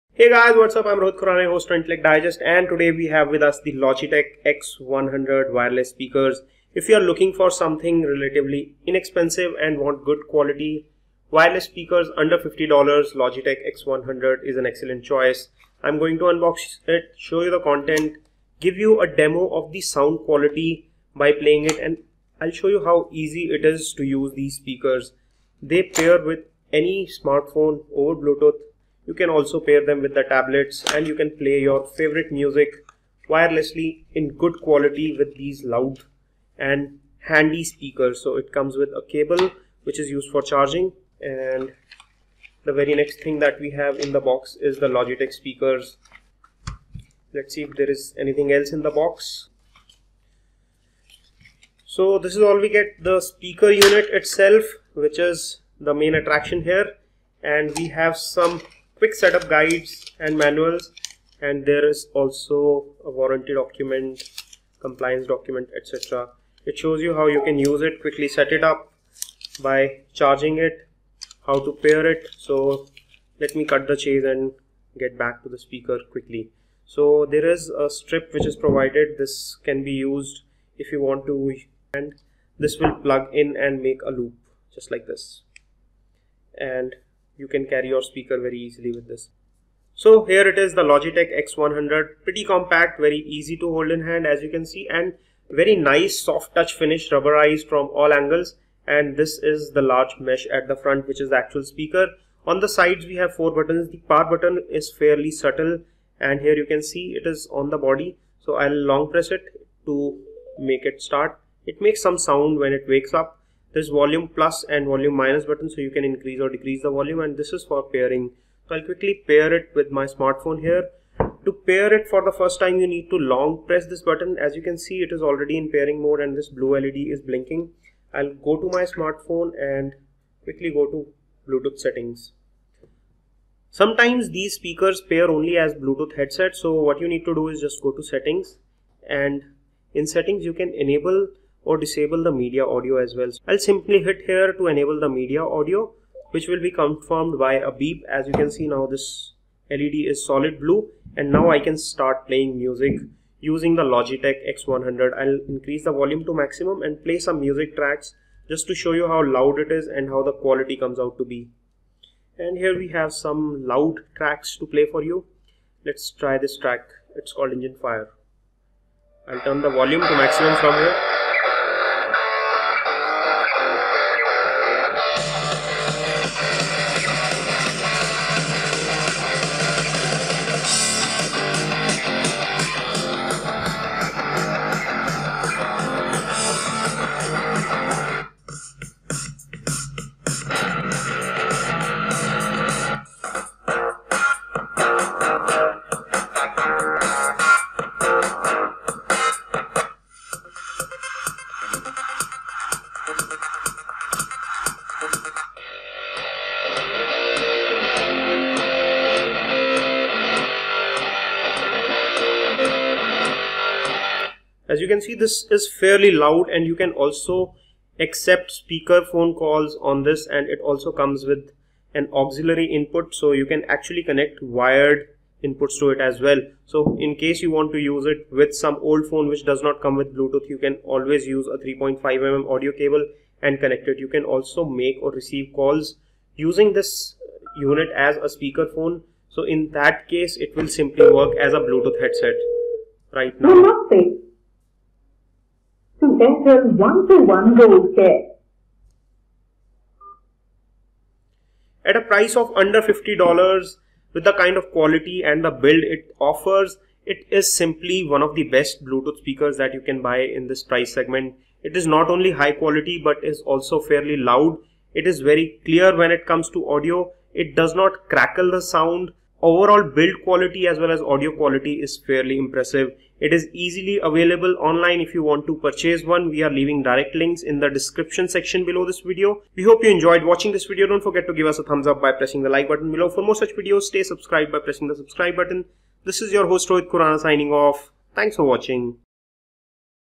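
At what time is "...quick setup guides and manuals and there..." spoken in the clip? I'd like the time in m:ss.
0:59.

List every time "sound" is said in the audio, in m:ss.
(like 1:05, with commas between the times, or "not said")
0:19, 1:52, 4:28.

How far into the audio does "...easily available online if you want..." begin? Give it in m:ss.
4:33.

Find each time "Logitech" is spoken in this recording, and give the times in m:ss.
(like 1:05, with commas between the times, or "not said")
0:03, 0:13, 0:44, 1:30, 2:33.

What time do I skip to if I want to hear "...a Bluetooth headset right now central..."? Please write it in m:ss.
4:01.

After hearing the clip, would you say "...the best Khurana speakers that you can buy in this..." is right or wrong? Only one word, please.
wrong.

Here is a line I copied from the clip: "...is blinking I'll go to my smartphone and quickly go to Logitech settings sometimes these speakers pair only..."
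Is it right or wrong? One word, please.
wrong.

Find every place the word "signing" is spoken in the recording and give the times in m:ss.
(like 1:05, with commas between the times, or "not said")
4:47.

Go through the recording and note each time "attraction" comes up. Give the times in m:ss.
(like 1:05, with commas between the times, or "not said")
0:56.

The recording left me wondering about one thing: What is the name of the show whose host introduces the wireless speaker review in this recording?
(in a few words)
Intellect Digest.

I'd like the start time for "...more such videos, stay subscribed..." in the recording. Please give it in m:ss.
4:43.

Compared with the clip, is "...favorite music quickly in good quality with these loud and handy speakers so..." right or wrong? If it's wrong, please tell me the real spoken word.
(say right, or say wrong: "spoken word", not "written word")
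wrong: "wirelessly", not "quickly".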